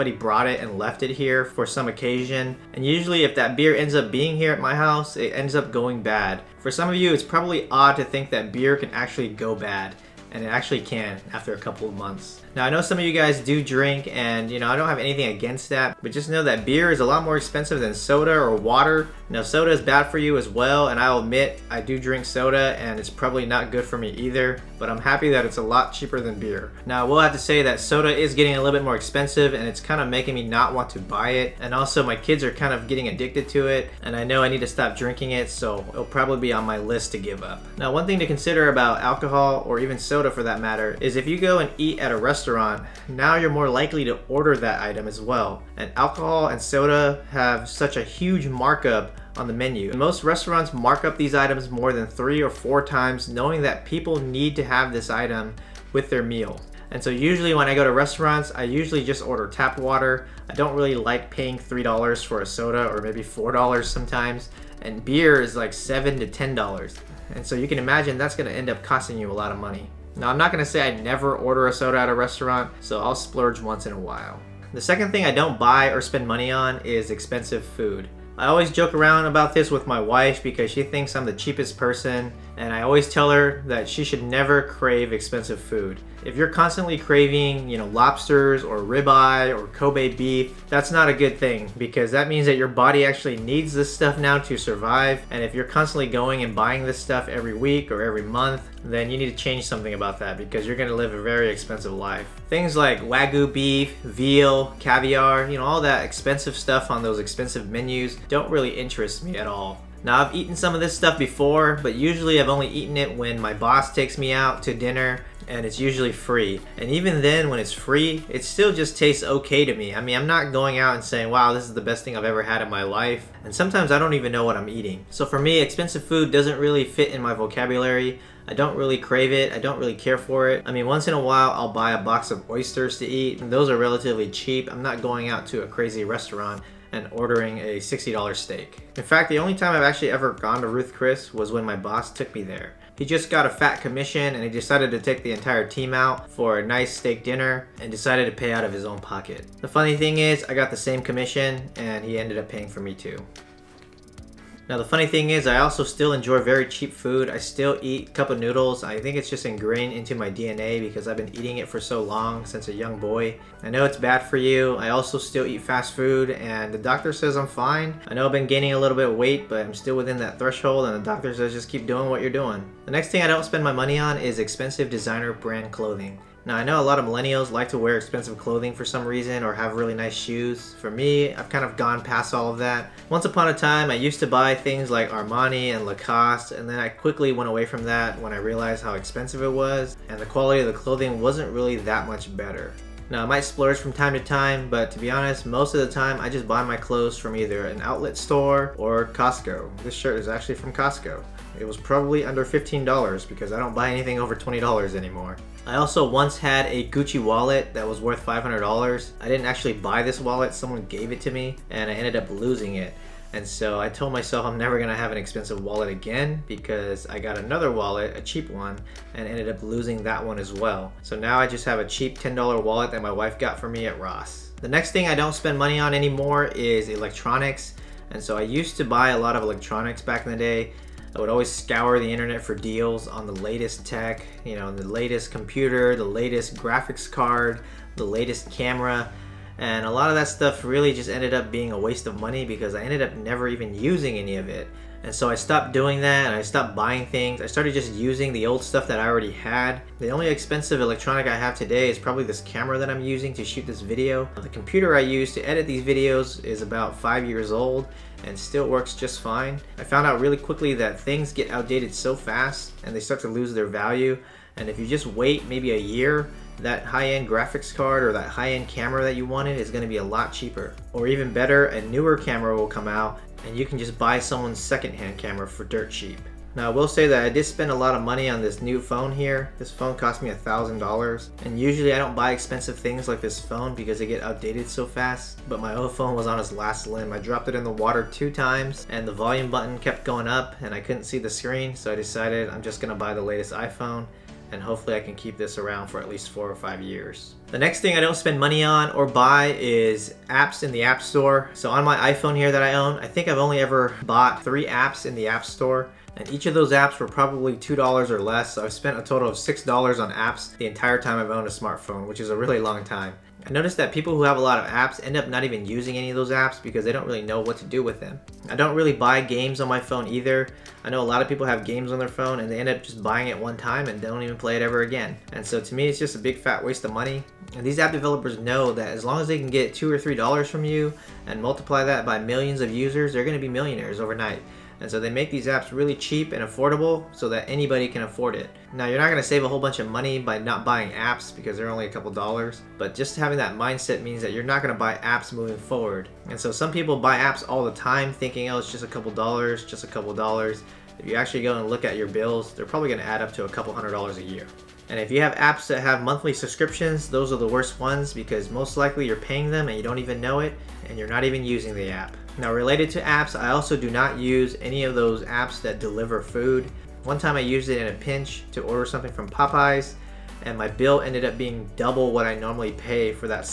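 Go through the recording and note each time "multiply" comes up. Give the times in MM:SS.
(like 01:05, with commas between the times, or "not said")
05:31.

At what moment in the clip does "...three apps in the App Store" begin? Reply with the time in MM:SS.
05:04.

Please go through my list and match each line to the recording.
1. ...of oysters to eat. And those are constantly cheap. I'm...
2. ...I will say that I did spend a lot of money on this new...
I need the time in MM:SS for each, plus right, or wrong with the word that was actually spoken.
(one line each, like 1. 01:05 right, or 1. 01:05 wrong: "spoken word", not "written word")
1. 02:12 wrong: "relatively", not "constantly"
2. 04:36 right.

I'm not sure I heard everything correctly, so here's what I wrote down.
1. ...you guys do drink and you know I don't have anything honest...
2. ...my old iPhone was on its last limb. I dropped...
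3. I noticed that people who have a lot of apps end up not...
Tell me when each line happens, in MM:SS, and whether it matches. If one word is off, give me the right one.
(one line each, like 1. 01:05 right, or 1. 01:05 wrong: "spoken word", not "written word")
1. 00:13 wrong: "against", not "honest"
2. 04:45 wrong: "phone", not "iPhone"
3. 05:13 right.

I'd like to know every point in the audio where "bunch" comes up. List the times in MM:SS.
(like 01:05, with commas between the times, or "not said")
05:39.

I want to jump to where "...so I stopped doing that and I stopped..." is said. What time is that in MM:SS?
04:05.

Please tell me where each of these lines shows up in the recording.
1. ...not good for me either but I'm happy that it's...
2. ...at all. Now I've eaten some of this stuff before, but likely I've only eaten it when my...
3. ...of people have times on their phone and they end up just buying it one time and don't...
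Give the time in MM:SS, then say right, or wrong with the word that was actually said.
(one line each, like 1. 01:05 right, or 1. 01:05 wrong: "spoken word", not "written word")
1. 00:23 right
2. 01:49 wrong: "usually", not "likely"
3. 05:21 wrong: "games", not "times".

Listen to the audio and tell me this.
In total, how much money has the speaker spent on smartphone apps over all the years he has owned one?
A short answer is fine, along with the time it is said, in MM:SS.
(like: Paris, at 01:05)
$6, at 05:09.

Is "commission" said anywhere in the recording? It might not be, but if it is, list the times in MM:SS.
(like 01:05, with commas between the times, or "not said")
02:23, 02:31.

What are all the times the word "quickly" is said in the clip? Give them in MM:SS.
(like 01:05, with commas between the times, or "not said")
03:06, 04:20.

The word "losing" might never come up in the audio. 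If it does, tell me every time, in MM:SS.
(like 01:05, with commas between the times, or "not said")
03:32, 03:39.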